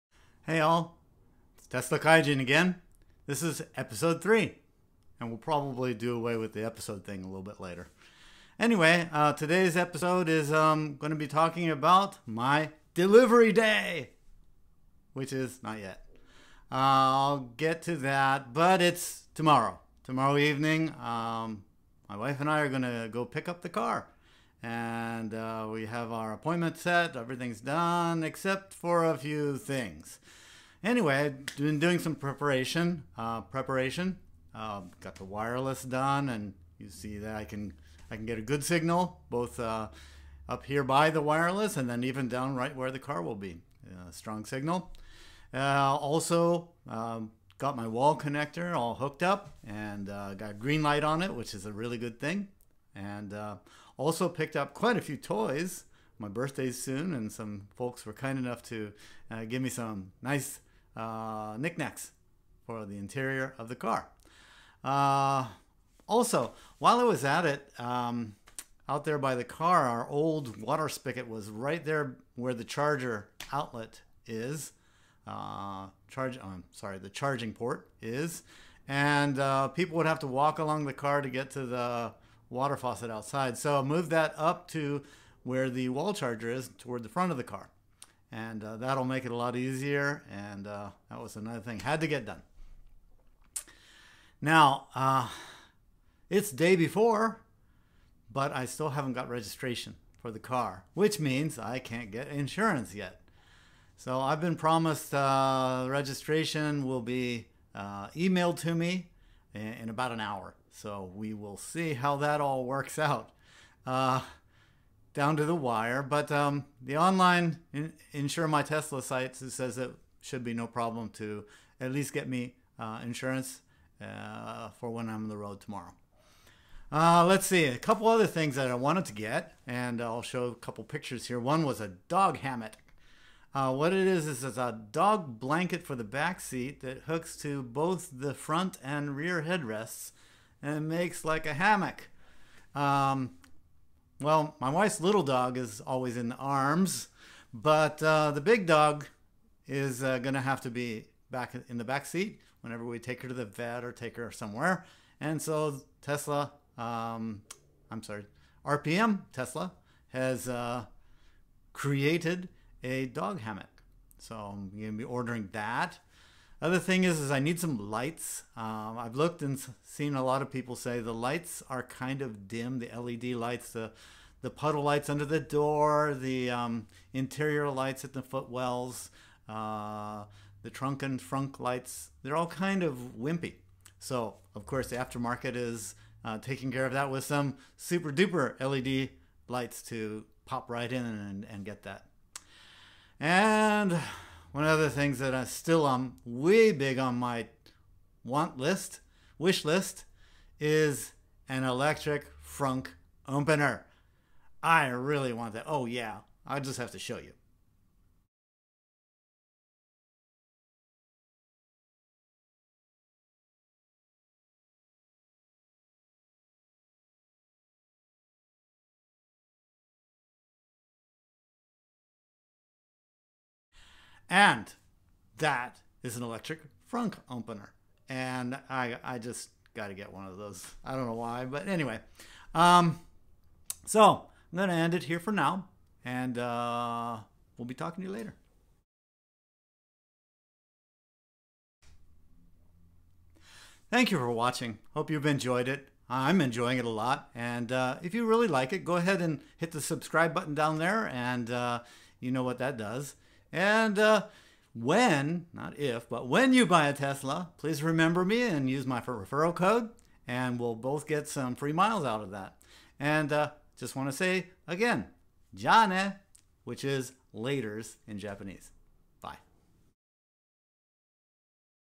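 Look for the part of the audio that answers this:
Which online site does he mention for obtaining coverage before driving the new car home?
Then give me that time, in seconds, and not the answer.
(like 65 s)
118 s.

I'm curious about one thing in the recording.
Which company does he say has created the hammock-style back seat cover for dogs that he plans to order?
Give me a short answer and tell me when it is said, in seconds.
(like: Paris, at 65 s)
RPM Tesla, at 158 s.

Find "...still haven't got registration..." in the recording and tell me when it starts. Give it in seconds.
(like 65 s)
98 s.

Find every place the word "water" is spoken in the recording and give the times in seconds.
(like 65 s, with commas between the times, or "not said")
70 s, 82 s.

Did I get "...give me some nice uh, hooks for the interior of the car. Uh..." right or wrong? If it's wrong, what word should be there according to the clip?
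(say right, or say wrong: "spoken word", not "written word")
wrong: "knickknacks", not "hooks".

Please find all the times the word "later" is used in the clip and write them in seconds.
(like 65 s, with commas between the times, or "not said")
7 s, 238 s, 267 s.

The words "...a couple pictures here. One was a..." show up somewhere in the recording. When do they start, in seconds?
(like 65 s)
130 s.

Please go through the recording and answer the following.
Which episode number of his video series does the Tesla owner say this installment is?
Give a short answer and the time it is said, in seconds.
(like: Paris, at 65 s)
3, at 3 s.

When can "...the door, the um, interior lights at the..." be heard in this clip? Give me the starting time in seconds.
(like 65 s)
175 s.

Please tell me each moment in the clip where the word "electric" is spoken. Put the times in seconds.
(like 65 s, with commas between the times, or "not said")
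201 s, 226 s.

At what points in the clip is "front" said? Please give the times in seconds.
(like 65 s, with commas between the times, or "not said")
87 s, 138 s.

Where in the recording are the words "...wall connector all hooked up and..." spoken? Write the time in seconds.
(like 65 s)
47 s.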